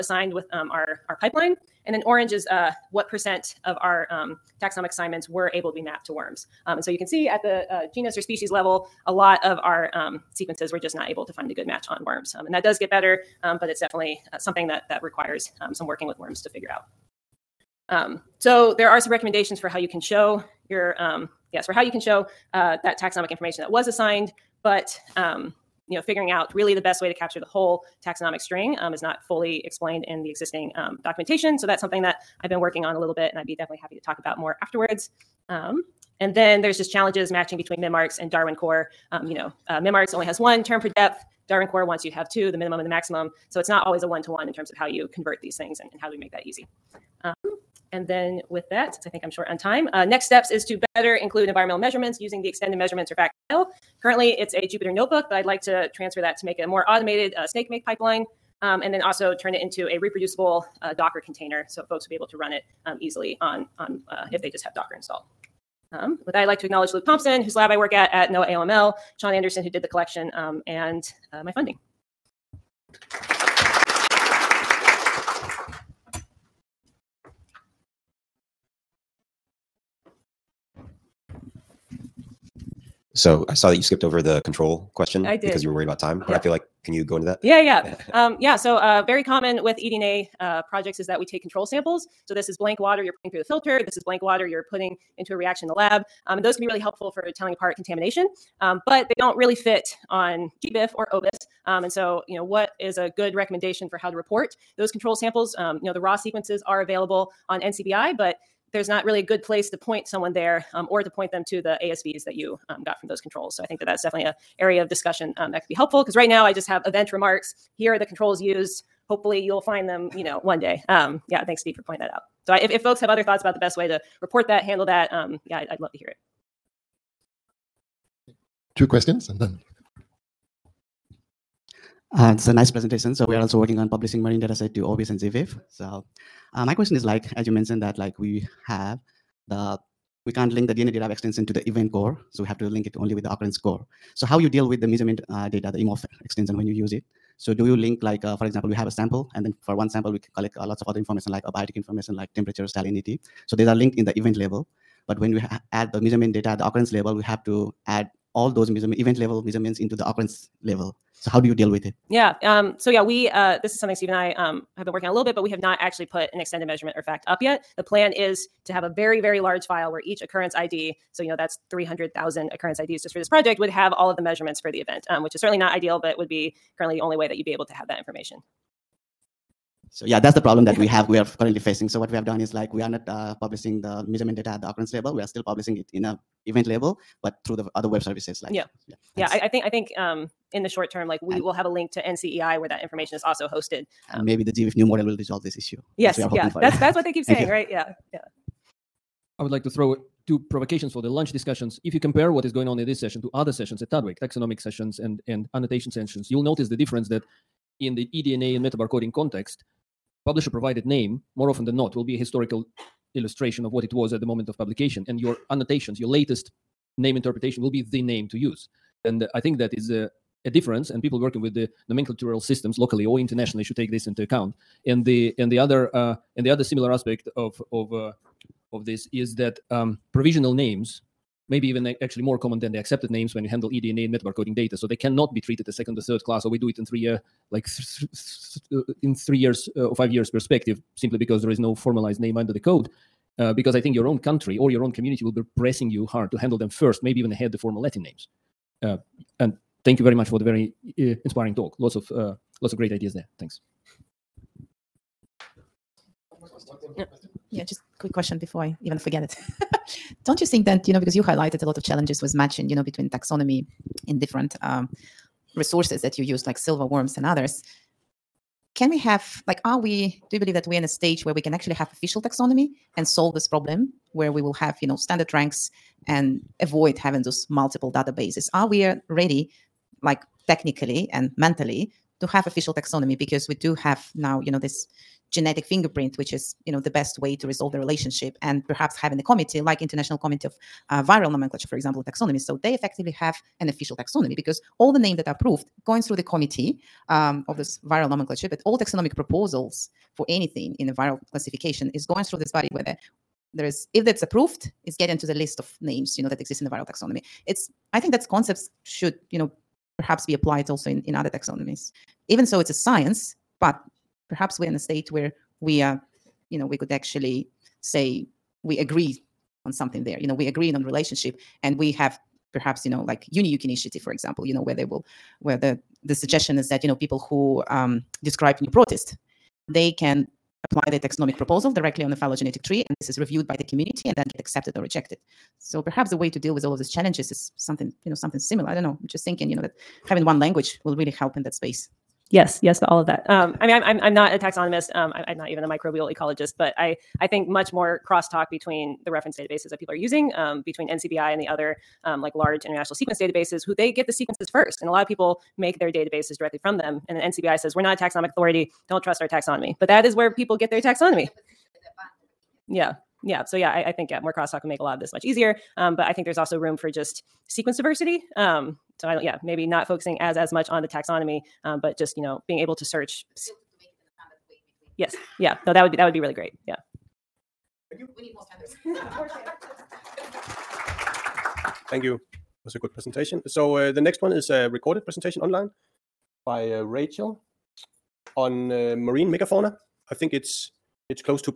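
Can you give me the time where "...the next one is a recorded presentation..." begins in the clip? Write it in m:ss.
6:23.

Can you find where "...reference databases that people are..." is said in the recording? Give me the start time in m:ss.
5:49.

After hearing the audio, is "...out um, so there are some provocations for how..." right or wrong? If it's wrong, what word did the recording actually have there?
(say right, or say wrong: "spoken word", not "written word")
wrong: "recommendations", not "provocations".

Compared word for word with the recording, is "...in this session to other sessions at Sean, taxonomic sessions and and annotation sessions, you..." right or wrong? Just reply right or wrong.
wrong.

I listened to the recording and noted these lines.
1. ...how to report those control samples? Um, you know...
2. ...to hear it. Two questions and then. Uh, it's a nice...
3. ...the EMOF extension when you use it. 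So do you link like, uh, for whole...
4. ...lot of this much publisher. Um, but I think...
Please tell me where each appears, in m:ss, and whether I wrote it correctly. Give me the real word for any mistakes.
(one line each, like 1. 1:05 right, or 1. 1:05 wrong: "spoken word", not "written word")
1. 1:43 right
2. 2:05 right
3. 2:25 wrong: "example", not "whole"
4. 6:04 wrong: "easier", not "publisher".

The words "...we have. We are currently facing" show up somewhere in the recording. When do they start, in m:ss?
3:00.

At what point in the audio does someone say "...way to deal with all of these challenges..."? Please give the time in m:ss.
5:36.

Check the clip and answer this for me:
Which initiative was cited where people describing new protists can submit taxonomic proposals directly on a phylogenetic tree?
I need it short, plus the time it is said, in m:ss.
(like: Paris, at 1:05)
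UniEuk, at 5:23.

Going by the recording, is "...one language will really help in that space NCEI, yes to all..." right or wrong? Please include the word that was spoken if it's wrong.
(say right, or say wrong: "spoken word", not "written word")
wrong: "Yes", not "NCEI".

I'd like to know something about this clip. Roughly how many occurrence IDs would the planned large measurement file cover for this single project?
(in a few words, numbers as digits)
300,000.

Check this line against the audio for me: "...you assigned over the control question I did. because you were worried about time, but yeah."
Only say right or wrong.
wrong.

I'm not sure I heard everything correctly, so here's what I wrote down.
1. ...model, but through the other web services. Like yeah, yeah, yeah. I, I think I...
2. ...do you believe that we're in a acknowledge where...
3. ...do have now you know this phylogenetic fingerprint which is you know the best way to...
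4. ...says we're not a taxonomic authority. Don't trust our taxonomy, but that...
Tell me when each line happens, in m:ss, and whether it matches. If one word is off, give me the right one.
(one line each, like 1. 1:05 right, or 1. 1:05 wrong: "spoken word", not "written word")
1. 3:06 wrong: "label", not "model"
2. 4:30 wrong: "stage", not "acknowledge"
3. 4:43 wrong: "genetic", not "phylogenetic"
4. 5:57 right.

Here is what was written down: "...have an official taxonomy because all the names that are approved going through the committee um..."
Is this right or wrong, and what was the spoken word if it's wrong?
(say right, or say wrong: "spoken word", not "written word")
right.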